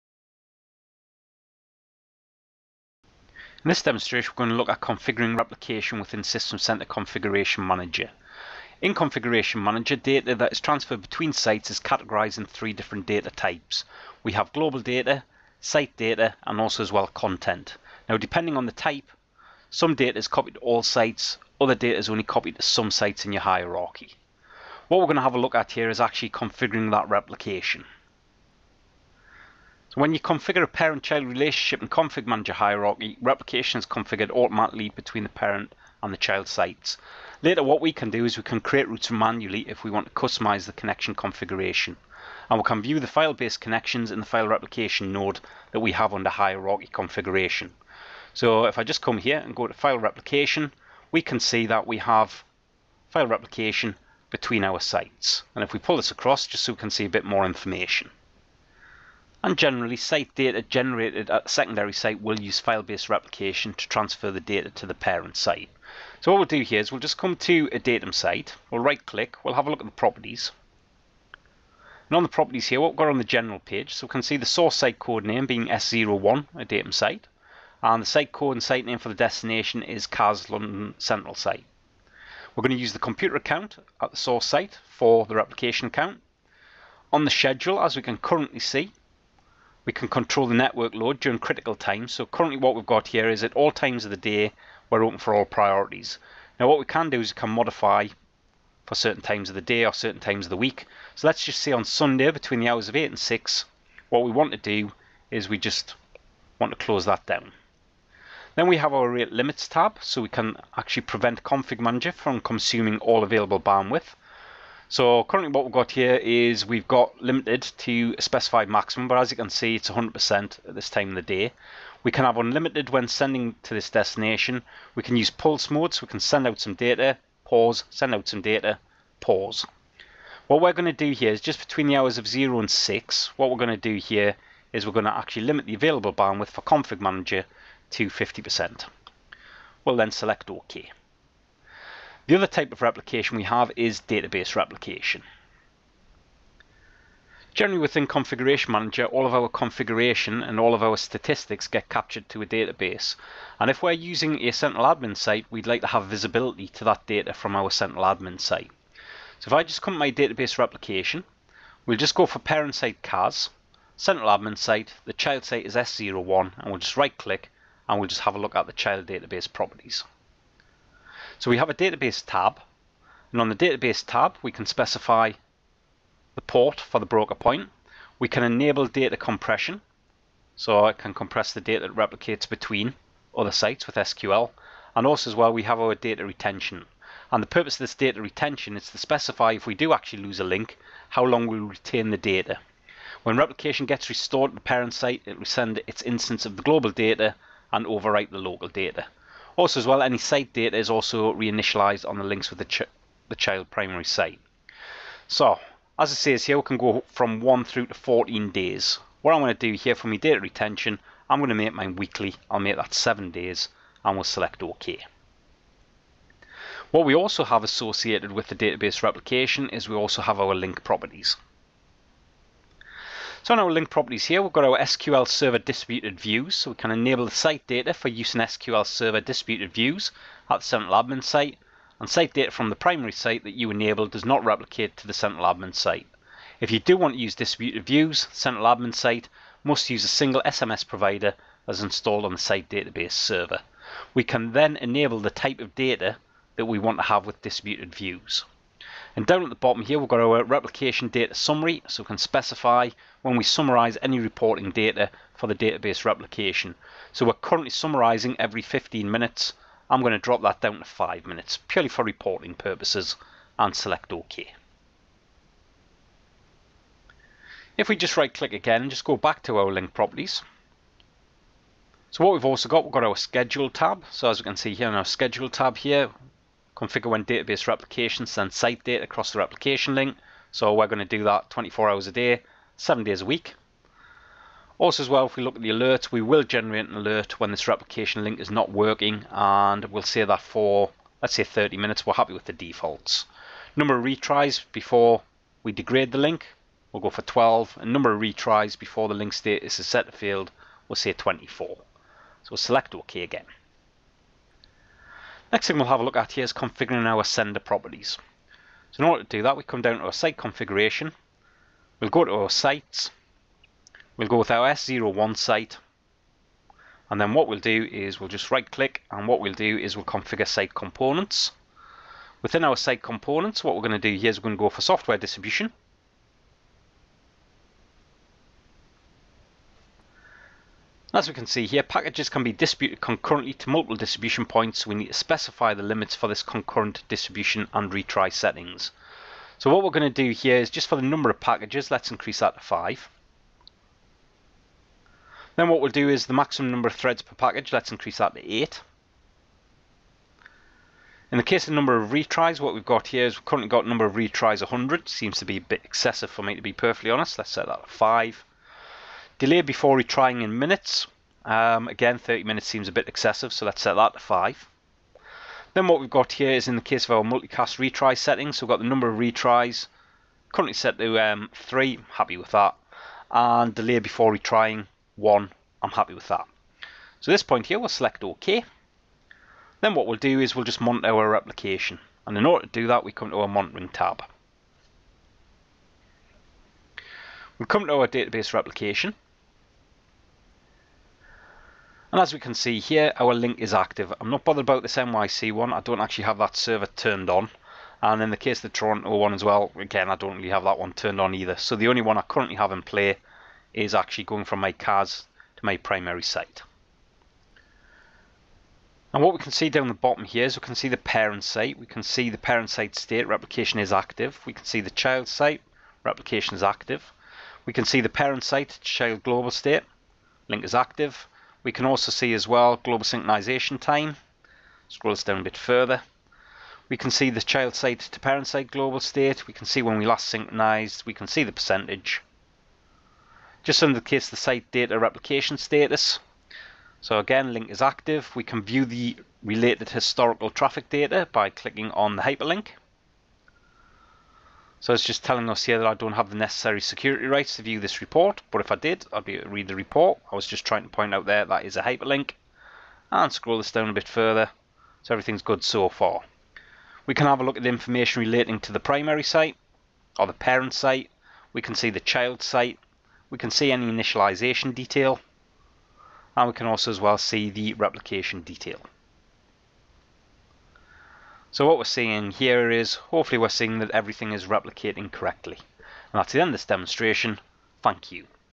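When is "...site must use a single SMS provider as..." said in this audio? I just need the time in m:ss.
3:58.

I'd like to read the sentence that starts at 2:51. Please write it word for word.
So we have a database tab, and on the database tab, we can specify the port for the broker point.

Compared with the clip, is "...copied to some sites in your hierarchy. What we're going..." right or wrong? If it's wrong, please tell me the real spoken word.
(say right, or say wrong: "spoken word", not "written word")
right.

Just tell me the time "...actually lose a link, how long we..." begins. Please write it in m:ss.
3:09.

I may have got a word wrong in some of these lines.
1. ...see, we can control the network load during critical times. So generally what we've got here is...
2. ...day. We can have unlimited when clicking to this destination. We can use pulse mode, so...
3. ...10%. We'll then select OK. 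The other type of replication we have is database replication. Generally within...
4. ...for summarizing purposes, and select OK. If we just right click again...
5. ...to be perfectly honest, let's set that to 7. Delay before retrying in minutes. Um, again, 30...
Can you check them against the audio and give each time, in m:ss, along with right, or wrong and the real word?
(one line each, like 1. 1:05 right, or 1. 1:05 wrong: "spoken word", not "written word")
1. 1:28 wrong: "currently", not "generally"
2. 2:01 wrong: "sending", not "clicking"
3. 2:18 wrong: "50", not "10"
4. 4:21 wrong: "reporting", not "summarizing"
5. 5:56 wrong: "5", not "7".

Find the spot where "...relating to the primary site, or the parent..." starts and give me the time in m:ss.
7:38.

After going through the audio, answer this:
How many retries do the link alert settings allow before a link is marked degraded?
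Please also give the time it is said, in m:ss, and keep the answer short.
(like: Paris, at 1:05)
12, at 4:57.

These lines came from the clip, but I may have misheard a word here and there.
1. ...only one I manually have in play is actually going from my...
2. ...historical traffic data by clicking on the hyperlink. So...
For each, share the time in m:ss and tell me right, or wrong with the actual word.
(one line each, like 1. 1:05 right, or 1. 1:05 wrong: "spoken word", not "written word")
1. 6:41 wrong: "currently", not "manually"
2. 7:19 right.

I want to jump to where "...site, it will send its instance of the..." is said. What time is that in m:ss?
3:14.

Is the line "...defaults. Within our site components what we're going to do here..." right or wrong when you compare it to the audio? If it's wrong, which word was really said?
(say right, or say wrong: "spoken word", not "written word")
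wrong: "components", not "defaults".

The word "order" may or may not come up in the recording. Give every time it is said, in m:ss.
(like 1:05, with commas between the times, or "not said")
5:09, 6:22.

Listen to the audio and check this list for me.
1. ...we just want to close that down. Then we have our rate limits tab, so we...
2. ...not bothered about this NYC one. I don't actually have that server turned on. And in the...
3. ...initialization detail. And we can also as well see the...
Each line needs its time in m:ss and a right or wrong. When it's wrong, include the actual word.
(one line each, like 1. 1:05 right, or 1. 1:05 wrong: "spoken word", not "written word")
1. 1:45 right
2. 6:34 right
3. 7:43 right.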